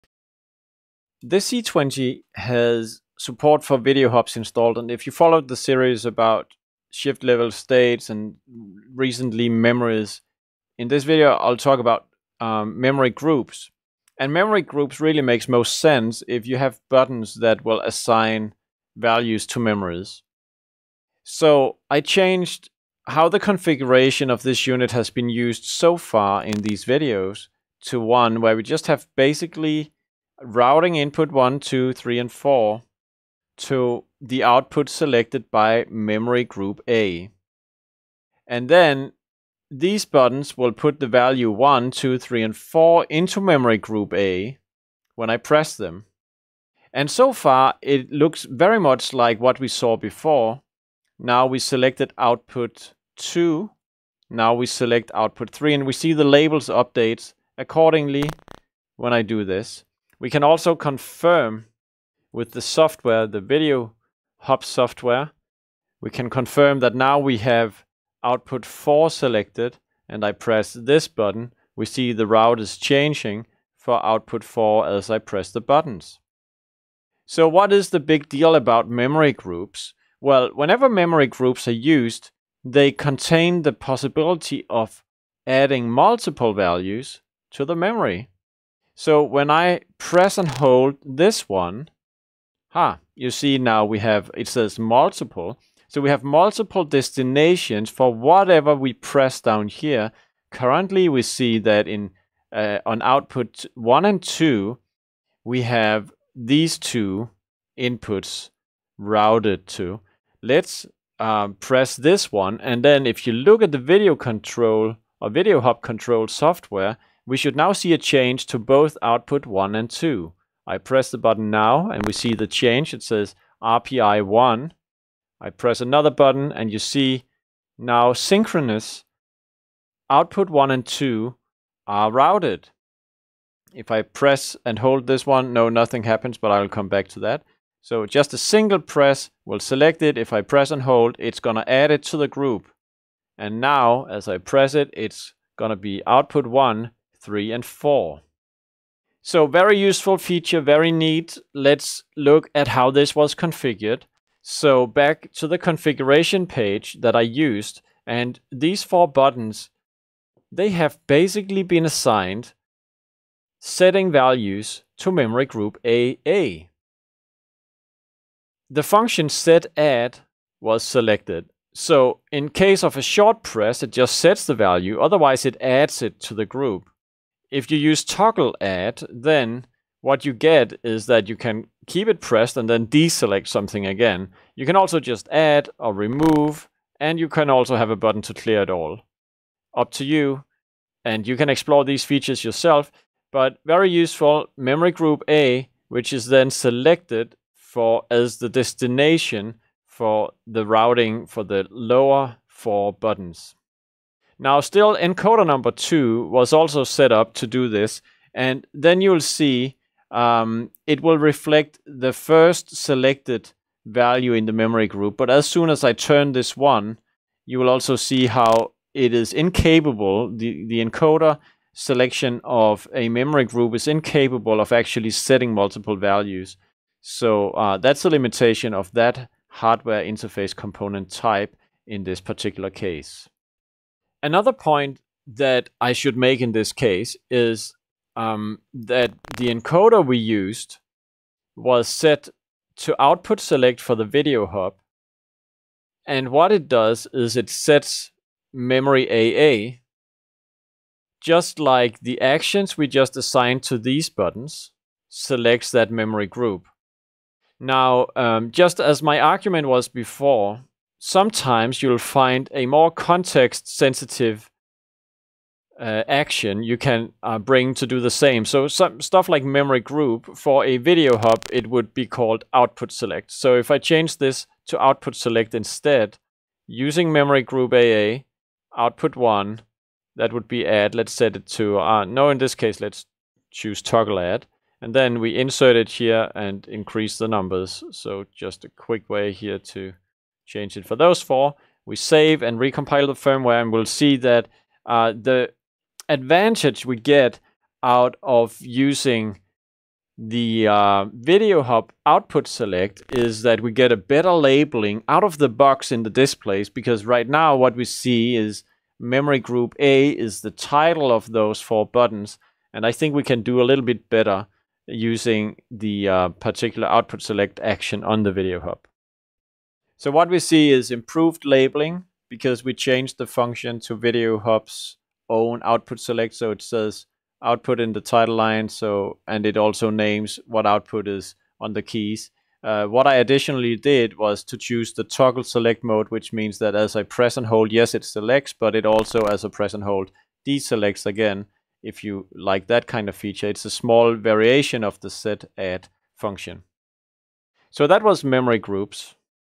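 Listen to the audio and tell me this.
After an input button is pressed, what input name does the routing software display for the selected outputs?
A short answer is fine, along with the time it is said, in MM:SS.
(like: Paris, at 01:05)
RPI 1, at 02:03.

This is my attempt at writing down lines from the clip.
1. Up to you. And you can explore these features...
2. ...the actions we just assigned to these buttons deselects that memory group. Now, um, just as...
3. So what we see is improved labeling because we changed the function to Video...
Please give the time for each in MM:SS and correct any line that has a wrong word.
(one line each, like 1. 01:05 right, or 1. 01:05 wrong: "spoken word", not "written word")
1. 03:09 right
2. 04:11 wrong: "selects", not "deselects"
3. 05:20 right.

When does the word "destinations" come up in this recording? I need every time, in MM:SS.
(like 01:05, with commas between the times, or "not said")
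01:36, 03:18.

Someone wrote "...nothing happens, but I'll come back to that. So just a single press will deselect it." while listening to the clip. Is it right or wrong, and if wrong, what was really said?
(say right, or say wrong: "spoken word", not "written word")
wrong: "select", not "deselect".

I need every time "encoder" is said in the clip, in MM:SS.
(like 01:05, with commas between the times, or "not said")
03:24, 03:40, 03:59.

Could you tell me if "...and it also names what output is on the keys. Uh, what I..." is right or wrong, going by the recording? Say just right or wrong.
right.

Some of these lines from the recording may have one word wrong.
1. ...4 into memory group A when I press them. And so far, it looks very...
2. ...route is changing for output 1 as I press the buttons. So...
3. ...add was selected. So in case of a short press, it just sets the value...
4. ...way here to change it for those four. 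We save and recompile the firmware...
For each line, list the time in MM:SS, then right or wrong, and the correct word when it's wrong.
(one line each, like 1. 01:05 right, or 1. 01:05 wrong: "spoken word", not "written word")
1. 00:42 right
2. 01:12 wrong: "4", not "1"
3. 02:49 right
4. 04:49 right.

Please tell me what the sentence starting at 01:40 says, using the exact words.
Currently, we see that in uh, on output one and two, we have these two inputs routed to.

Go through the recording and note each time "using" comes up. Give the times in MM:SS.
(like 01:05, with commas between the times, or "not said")
04:36, 04:58, 05:14.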